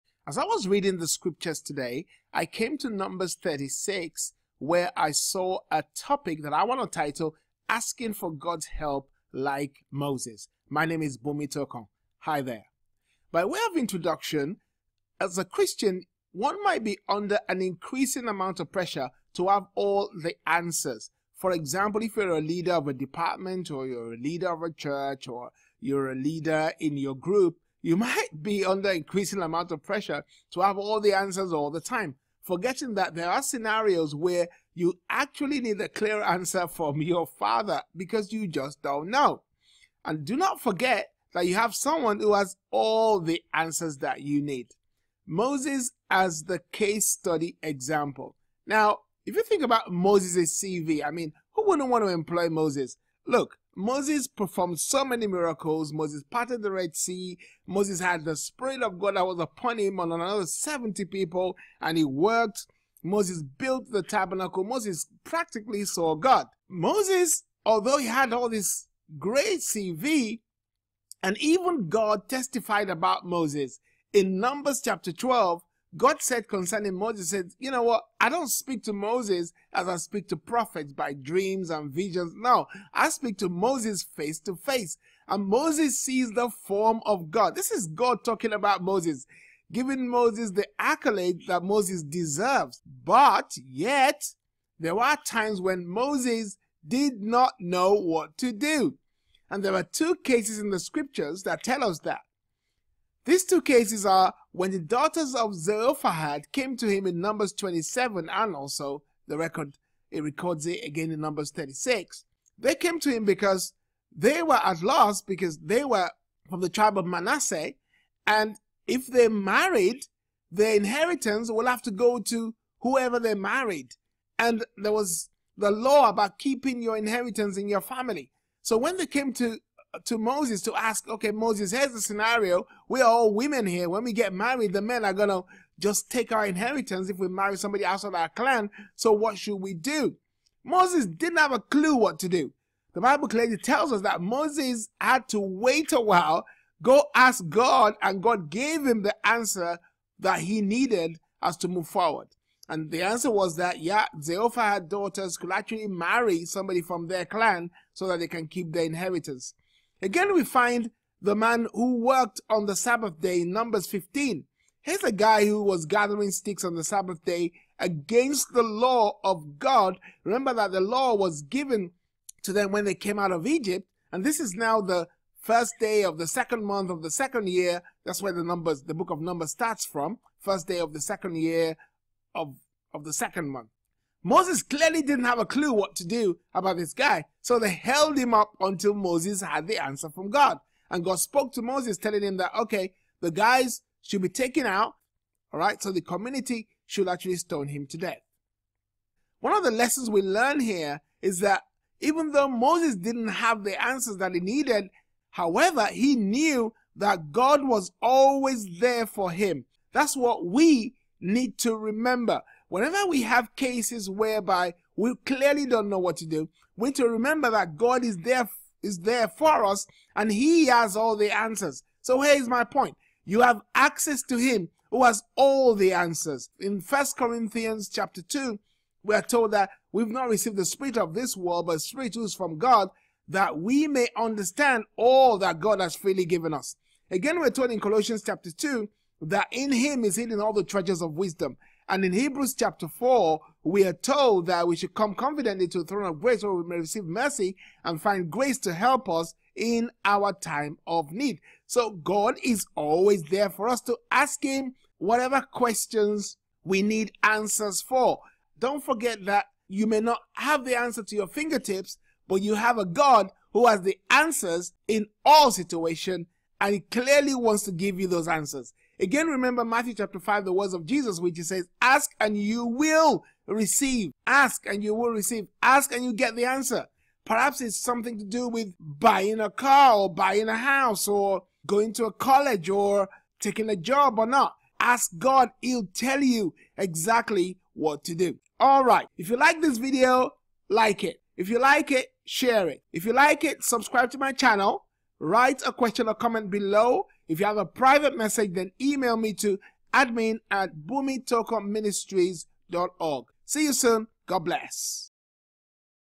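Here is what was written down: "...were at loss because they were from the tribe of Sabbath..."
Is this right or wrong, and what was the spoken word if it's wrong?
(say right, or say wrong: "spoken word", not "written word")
wrong: "Manasseh", not "Sabbath".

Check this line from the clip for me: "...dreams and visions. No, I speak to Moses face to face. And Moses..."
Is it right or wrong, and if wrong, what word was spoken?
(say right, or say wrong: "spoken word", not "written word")
right.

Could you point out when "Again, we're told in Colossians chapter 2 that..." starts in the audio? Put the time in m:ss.
3:57.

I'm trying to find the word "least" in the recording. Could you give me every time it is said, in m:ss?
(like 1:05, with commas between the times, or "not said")
not said.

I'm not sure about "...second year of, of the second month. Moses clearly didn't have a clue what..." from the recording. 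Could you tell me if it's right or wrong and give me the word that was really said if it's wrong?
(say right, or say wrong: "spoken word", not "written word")
right.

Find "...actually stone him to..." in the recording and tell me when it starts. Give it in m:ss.
3:17.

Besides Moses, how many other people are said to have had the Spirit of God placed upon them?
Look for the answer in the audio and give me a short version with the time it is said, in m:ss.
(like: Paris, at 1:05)
70, at 1:00.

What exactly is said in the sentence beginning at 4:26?
And he clearly wants to give you those answers.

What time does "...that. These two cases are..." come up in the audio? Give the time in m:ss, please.
1:41.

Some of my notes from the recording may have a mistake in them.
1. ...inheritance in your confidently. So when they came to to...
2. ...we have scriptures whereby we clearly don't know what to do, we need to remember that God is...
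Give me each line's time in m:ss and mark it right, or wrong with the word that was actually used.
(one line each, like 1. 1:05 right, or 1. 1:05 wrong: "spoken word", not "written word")
1. 2:06 wrong: "family", not "confidently"
2. 3:33 wrong: "cases", not "scriptures".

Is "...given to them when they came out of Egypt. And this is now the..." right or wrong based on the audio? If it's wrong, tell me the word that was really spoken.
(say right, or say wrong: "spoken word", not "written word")
right.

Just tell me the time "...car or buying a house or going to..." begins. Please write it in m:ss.
4:39.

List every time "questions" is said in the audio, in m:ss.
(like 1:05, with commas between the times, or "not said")
4:15, 4:55.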